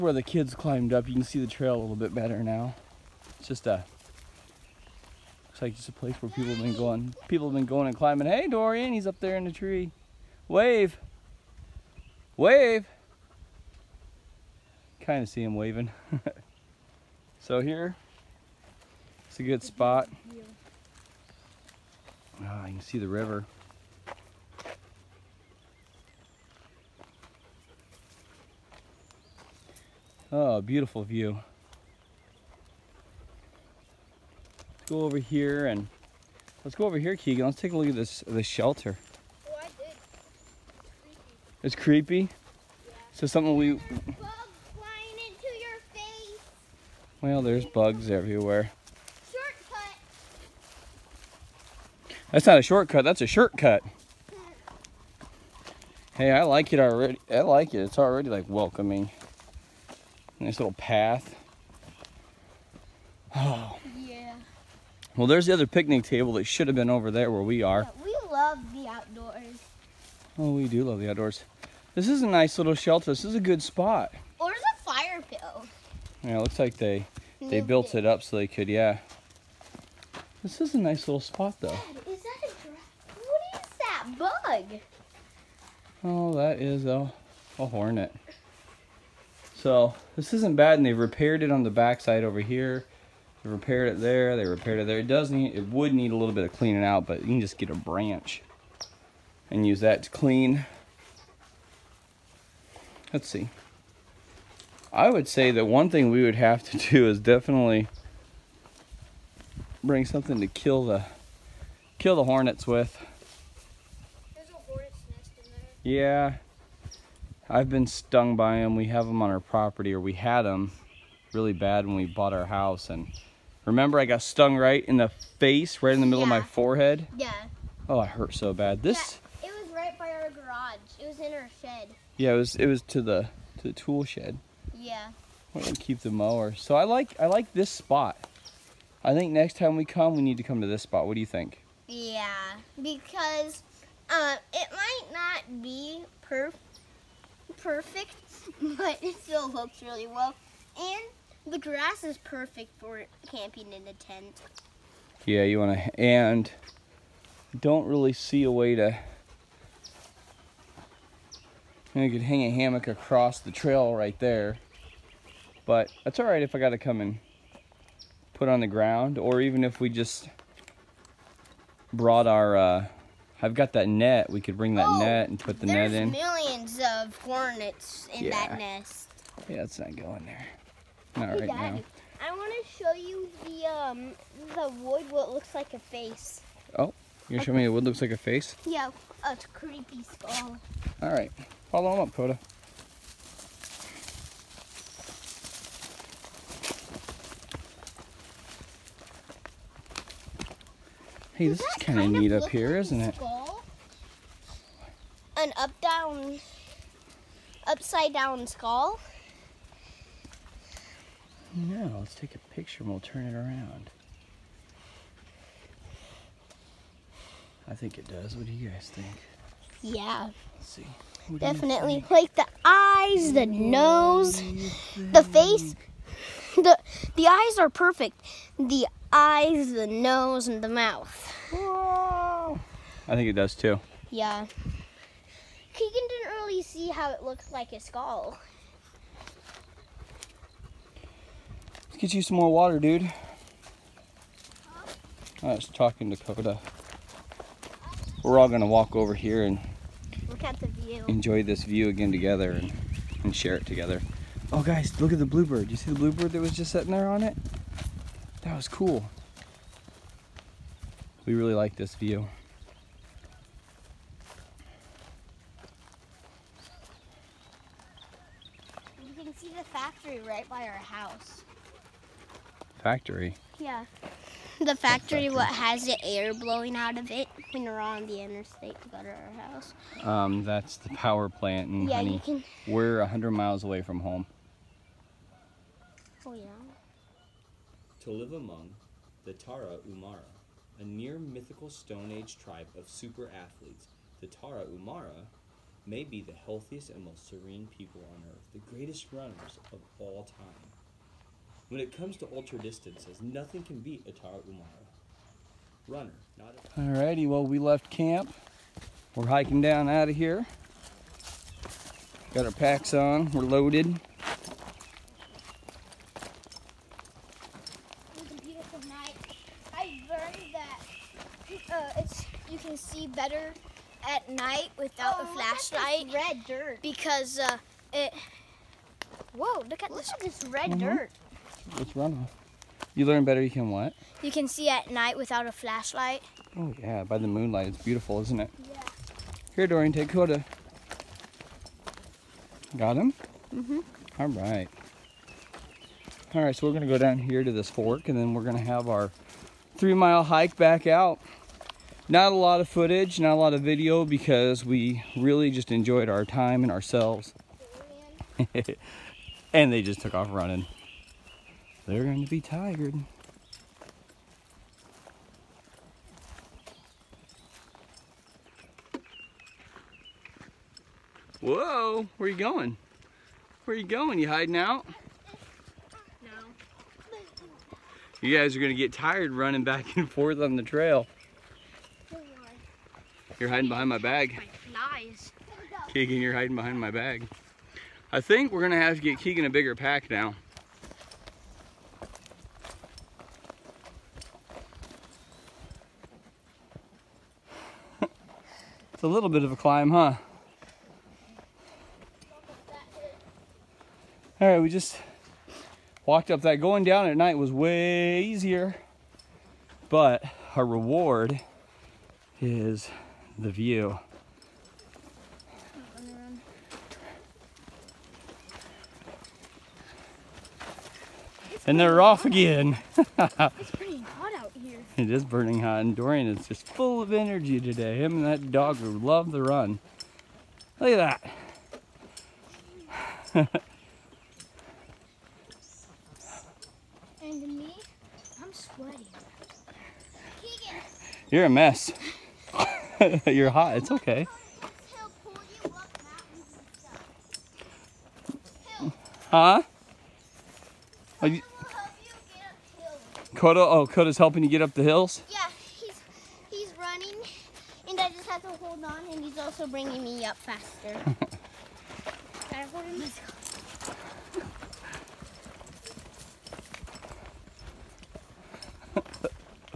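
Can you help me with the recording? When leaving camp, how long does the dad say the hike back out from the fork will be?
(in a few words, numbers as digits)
3 miles.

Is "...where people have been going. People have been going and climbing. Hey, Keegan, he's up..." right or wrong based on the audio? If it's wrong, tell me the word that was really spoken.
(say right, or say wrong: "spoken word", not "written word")
wrong: "Dorian", not "Keegan".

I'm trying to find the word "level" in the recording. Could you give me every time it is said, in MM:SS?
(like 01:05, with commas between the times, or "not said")
not said.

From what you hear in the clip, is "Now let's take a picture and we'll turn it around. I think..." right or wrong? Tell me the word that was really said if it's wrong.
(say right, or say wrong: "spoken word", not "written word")
right.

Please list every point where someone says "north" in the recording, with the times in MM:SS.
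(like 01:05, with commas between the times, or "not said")
not said.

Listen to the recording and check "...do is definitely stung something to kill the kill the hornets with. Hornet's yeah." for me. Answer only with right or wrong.
wrong.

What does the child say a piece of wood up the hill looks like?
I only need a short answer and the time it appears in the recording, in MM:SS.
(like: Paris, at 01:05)
a creepy skull, at 03:09.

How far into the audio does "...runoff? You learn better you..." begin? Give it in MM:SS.
05:32.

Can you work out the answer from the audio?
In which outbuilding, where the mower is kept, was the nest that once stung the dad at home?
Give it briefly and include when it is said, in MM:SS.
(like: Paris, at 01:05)
tool shed, at 02:13.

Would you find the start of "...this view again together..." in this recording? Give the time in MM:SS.
04:11.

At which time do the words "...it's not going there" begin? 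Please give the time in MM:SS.
02:59.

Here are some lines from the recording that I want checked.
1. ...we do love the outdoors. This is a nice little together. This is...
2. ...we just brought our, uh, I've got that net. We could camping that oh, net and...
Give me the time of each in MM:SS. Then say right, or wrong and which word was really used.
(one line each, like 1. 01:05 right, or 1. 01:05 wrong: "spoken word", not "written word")
1. 01:10 wrong: "shelter", not "together"
2. 02:49 wrong: "bring", not "camping".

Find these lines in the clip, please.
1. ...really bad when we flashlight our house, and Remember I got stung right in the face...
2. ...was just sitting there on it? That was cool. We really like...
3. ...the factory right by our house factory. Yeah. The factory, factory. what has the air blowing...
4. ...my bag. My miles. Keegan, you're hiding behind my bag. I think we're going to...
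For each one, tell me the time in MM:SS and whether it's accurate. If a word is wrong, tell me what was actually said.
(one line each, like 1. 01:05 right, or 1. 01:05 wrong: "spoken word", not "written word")
1. 02:01 wrong: "bought", not "flashlight"
2. 04:16 right
3. 04:29 right
4. 06:23 wrong: "flies", not "miles".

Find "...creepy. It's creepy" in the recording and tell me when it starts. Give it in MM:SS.
00:39.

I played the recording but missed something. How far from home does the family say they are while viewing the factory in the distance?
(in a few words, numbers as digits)
100 miles.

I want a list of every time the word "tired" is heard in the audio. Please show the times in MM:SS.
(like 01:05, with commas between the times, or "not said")
06:02, 06:18.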